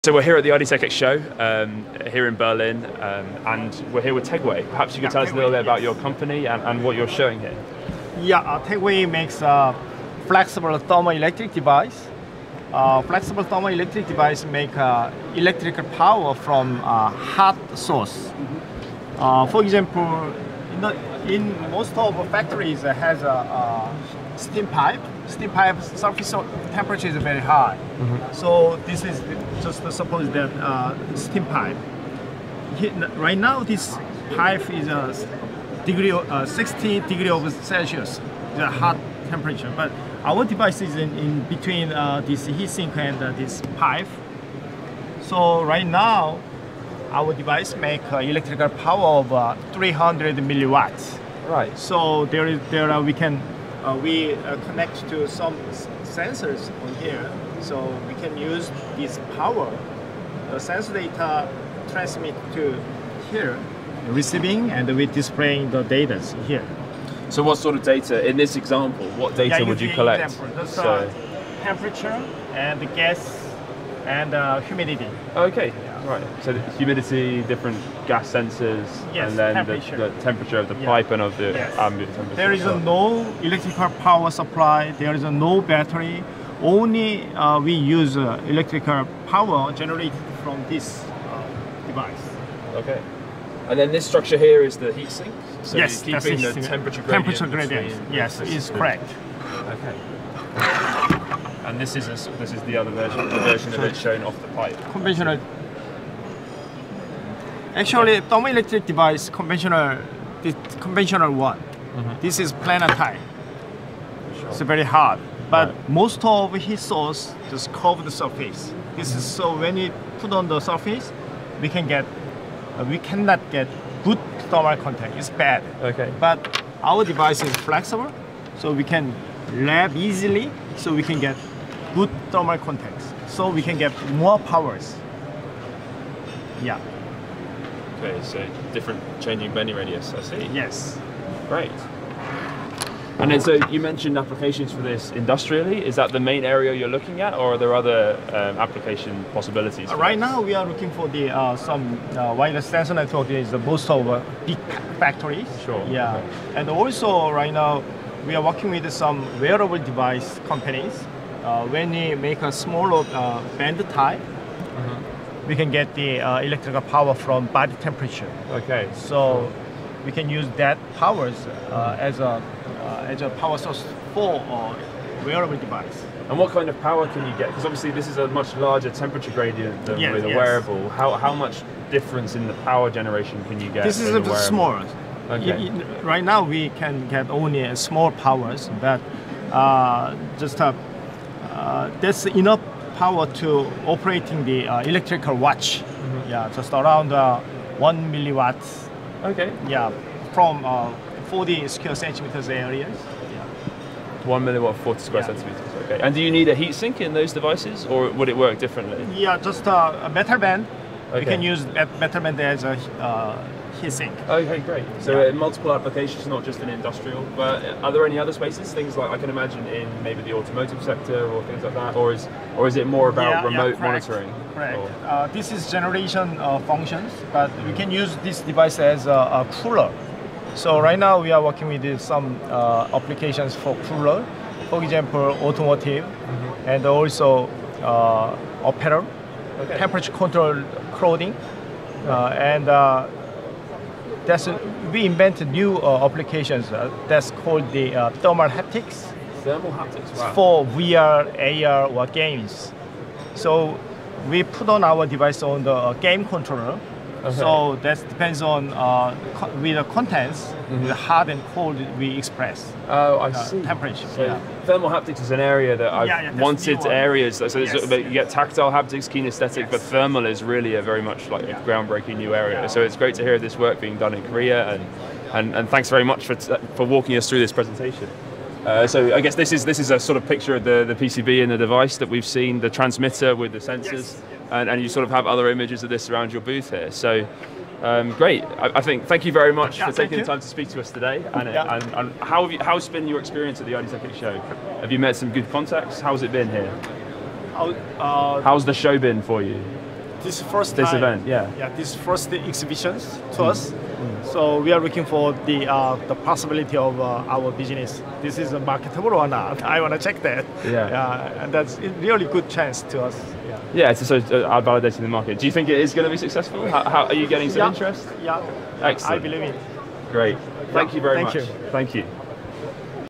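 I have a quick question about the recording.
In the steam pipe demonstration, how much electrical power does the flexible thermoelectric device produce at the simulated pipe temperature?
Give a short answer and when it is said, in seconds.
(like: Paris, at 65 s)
300 milliwatts, at 49 s.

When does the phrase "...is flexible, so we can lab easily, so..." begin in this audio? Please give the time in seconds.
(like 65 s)
127 s.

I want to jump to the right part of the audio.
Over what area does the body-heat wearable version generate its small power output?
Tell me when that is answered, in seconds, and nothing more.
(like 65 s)
201 s.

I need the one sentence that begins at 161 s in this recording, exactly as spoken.
Uh, when they make a smaller uh, band type, mm -hmm we can get the uh, electrical power from body temperature.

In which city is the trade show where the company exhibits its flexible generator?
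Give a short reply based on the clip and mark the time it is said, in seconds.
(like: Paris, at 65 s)
Berlin, at 2 s.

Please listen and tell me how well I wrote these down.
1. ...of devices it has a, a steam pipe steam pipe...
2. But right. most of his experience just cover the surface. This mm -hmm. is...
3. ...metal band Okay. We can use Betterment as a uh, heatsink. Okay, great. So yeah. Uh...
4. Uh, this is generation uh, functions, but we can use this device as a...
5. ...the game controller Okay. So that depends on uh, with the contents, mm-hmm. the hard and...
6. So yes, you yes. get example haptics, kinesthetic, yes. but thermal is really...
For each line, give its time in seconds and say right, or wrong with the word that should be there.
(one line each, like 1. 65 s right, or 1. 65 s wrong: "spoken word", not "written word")
1. 21 s wrong: "factories", not "devices"
2. 115 s wrong: "source", not "experience"
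3. 210 s right
4. 225 s right
5. 255 s right
6. 267 s wrong: "tactile", not "example".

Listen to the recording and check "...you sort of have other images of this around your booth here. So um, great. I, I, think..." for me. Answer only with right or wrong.
right.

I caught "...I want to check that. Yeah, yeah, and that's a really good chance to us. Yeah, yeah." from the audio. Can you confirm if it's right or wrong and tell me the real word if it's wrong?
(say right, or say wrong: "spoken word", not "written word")
right.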